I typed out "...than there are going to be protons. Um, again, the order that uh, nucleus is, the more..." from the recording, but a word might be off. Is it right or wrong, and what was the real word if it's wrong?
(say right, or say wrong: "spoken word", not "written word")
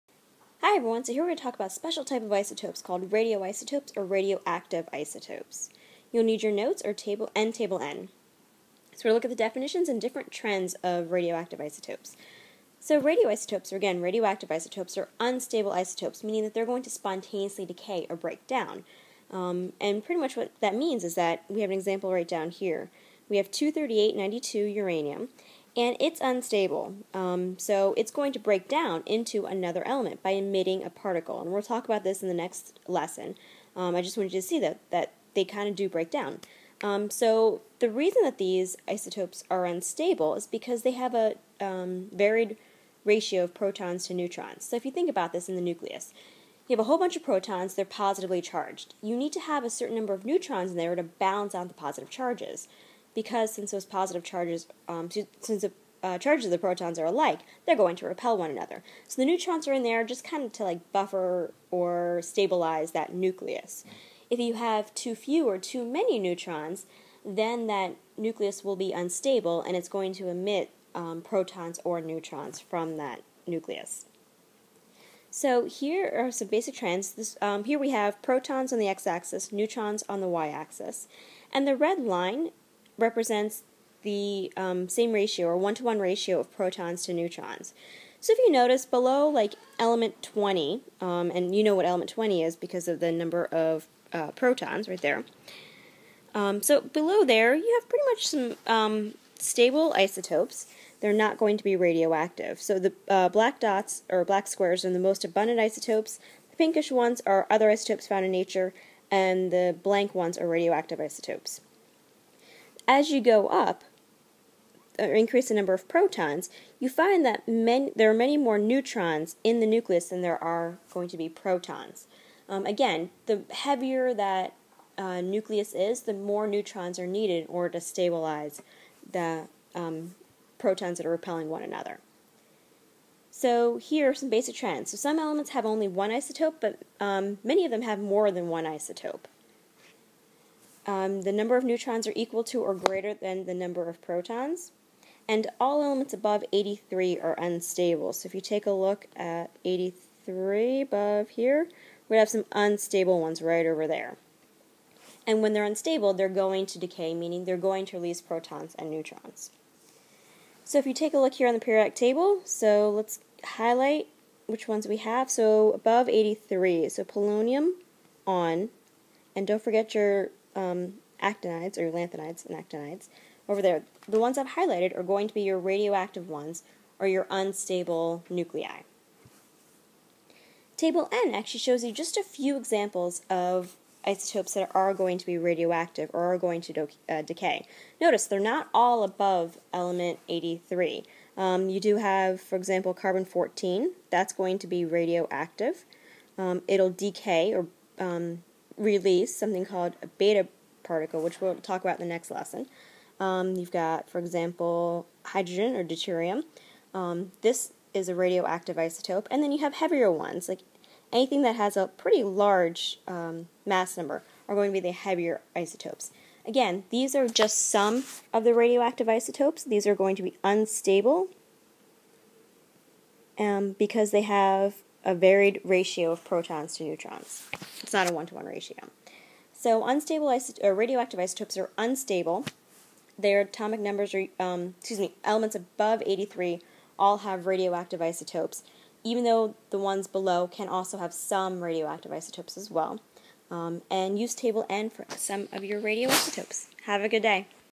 wrong: "heavier", not "order".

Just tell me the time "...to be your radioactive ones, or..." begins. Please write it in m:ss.
2:55.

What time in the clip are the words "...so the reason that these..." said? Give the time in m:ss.
0:37.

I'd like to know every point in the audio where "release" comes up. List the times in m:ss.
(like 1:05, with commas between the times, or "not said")
2:37, 3:18.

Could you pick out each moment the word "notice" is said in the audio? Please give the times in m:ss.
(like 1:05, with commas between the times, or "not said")
1:28, 3:07.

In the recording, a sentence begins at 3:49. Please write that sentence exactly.
So unstable or uh, radioactive isotopes are unstable.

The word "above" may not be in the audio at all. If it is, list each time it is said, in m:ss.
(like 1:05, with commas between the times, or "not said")
2:26, 2:30, 2:45, 3:09, 3:55.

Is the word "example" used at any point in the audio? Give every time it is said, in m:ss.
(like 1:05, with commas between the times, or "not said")
0:21, 3:02, 3:12, 3:24.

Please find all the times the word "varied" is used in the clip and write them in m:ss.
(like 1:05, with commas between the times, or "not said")
0:42, 3:45.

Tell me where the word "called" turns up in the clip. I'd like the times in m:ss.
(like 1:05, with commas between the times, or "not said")
0:02, 3:19.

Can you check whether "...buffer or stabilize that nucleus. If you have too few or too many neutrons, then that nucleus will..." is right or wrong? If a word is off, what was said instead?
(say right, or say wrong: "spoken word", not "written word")
right.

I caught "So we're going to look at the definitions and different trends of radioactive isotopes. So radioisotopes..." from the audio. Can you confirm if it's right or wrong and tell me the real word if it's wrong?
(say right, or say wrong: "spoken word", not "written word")
right.